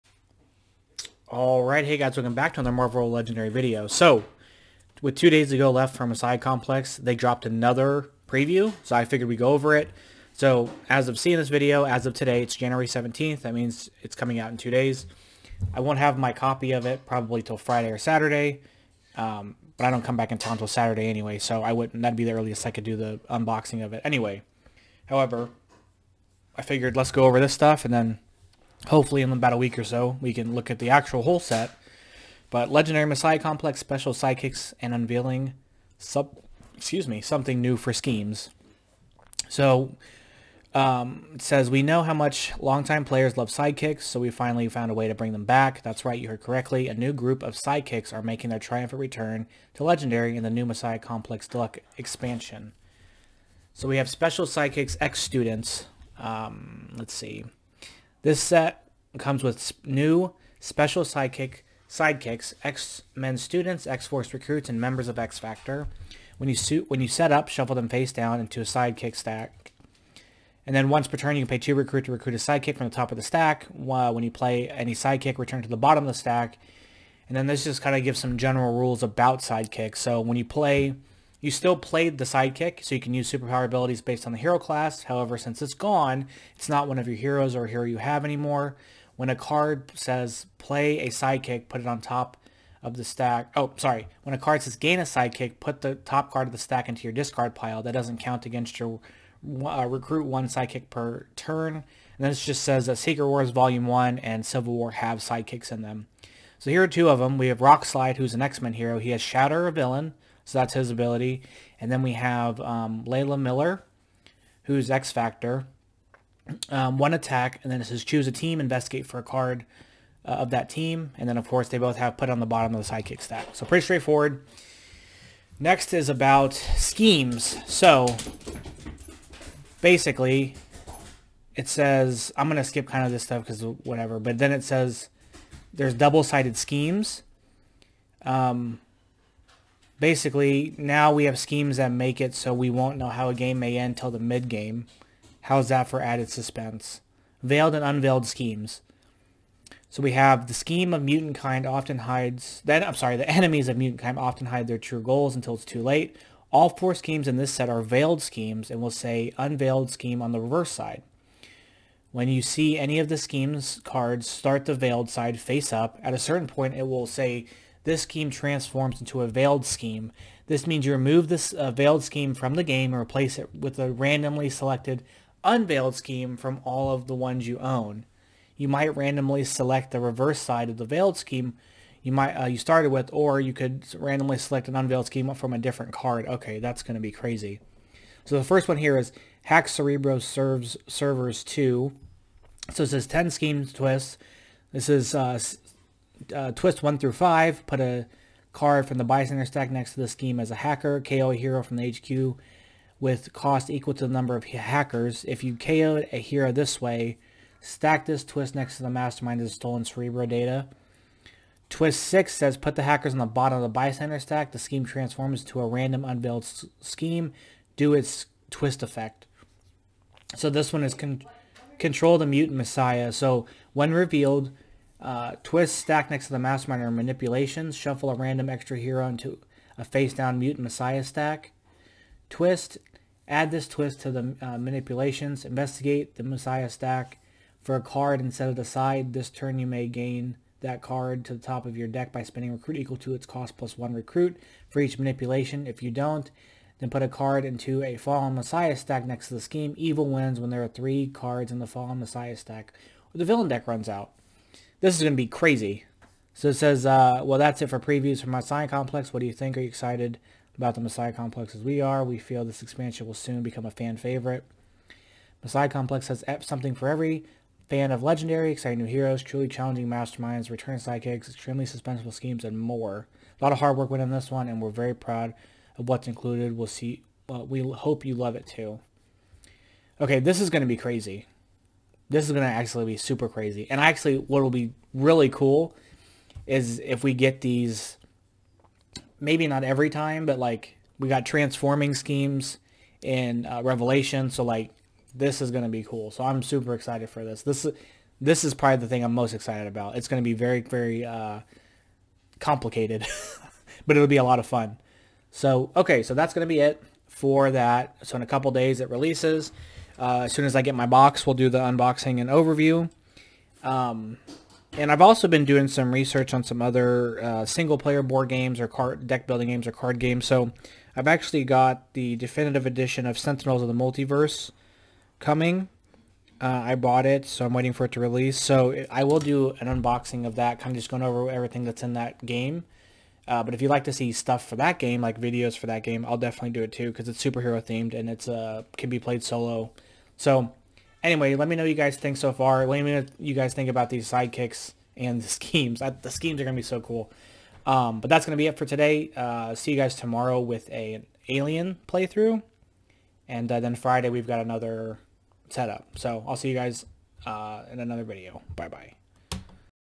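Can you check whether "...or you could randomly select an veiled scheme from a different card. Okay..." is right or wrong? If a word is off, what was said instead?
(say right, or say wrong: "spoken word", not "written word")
wrong: "unveiled", not "veiled".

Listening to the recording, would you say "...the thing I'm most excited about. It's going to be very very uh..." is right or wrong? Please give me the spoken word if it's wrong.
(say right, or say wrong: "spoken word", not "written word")
right.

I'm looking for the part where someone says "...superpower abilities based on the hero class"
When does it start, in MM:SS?
01:23.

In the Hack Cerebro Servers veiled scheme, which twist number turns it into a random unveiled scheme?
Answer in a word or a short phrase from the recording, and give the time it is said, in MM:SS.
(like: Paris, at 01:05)
6, at 03:31.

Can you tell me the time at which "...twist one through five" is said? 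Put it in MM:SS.
03:16.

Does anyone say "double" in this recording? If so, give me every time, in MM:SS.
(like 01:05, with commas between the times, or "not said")
02:15.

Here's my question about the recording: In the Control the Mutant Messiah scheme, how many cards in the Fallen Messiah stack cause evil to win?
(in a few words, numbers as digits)
3.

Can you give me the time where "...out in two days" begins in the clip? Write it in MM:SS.
00:14.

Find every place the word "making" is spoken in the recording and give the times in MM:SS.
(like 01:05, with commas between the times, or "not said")
00:48.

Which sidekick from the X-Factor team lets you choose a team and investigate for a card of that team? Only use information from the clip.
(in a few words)
Layla Miller.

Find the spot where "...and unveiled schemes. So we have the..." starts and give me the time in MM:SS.
02:27.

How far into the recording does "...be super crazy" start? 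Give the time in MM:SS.
04:42.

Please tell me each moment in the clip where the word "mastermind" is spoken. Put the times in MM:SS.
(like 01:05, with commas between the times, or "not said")
03:28, 03:46, 04:29.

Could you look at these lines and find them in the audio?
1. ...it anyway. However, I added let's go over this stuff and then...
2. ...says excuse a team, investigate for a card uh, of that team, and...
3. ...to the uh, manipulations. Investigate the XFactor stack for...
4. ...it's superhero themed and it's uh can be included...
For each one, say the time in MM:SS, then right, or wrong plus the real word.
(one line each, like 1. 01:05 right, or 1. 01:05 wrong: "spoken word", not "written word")
1. 00:23 wrong: "figured", not "added"
2. 01:57 wrong: "choose", not "excuse"
3. 03:54 wrong: "Messiah", not "XFactor"
4. 05:37 wrong: "played", not "included".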